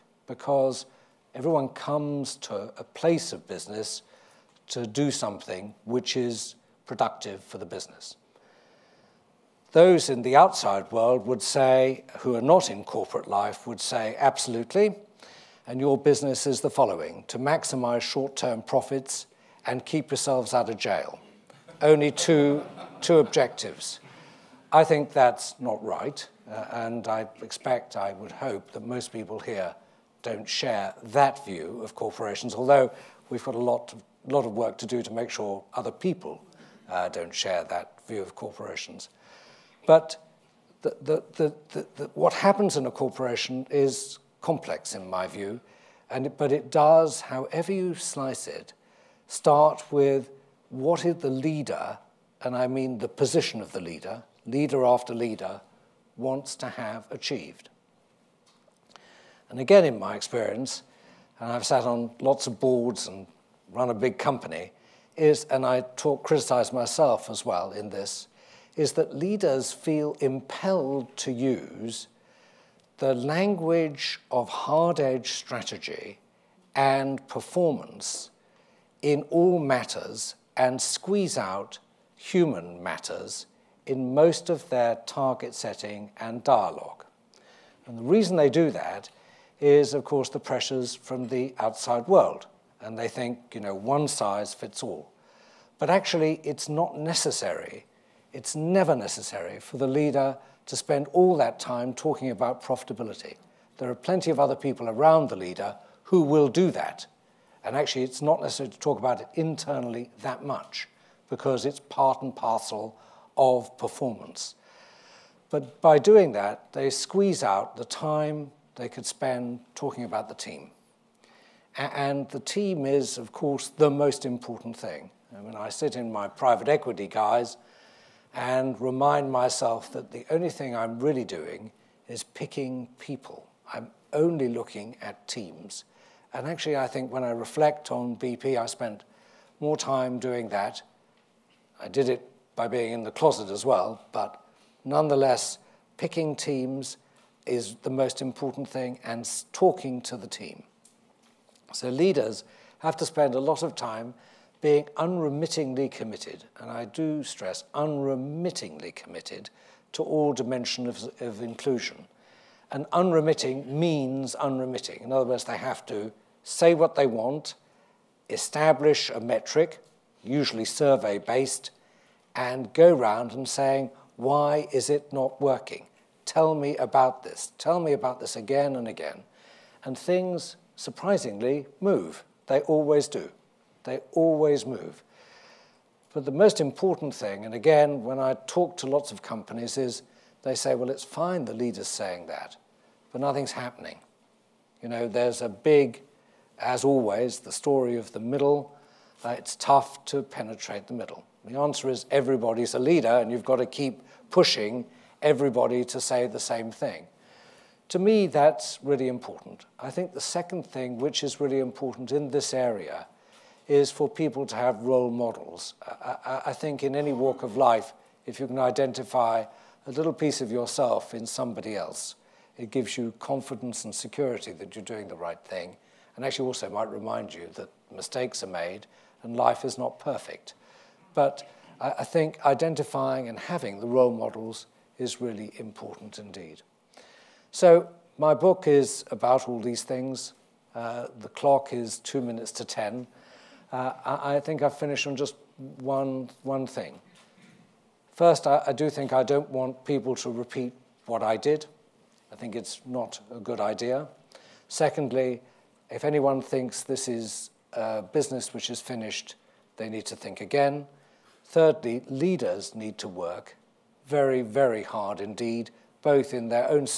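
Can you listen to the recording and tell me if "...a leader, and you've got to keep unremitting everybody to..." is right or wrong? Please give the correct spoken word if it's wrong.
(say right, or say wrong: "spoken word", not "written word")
wrong: "pushing", not "unremitting".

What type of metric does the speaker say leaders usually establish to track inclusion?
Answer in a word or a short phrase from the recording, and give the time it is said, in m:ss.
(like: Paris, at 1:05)
survey-based, at 2:50.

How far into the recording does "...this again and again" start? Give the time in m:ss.
2:58.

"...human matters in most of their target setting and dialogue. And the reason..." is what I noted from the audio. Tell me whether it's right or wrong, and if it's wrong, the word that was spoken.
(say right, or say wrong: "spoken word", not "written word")
right.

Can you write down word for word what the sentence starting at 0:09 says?
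Those in the outside world would say, who are not in corporate life, would say, absolutely.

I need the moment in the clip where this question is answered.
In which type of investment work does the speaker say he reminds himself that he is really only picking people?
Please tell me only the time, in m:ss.
2:06.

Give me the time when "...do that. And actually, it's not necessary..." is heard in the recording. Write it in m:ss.
1:46.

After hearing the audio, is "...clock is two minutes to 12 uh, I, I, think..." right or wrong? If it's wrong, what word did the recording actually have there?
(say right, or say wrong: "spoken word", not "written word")
wrong: "10", not "12".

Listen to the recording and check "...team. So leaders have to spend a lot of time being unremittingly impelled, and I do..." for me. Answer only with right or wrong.
wrong.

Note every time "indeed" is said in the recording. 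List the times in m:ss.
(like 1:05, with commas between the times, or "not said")
3:56, 4:25.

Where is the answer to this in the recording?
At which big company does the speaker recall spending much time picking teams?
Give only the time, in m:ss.
2:18.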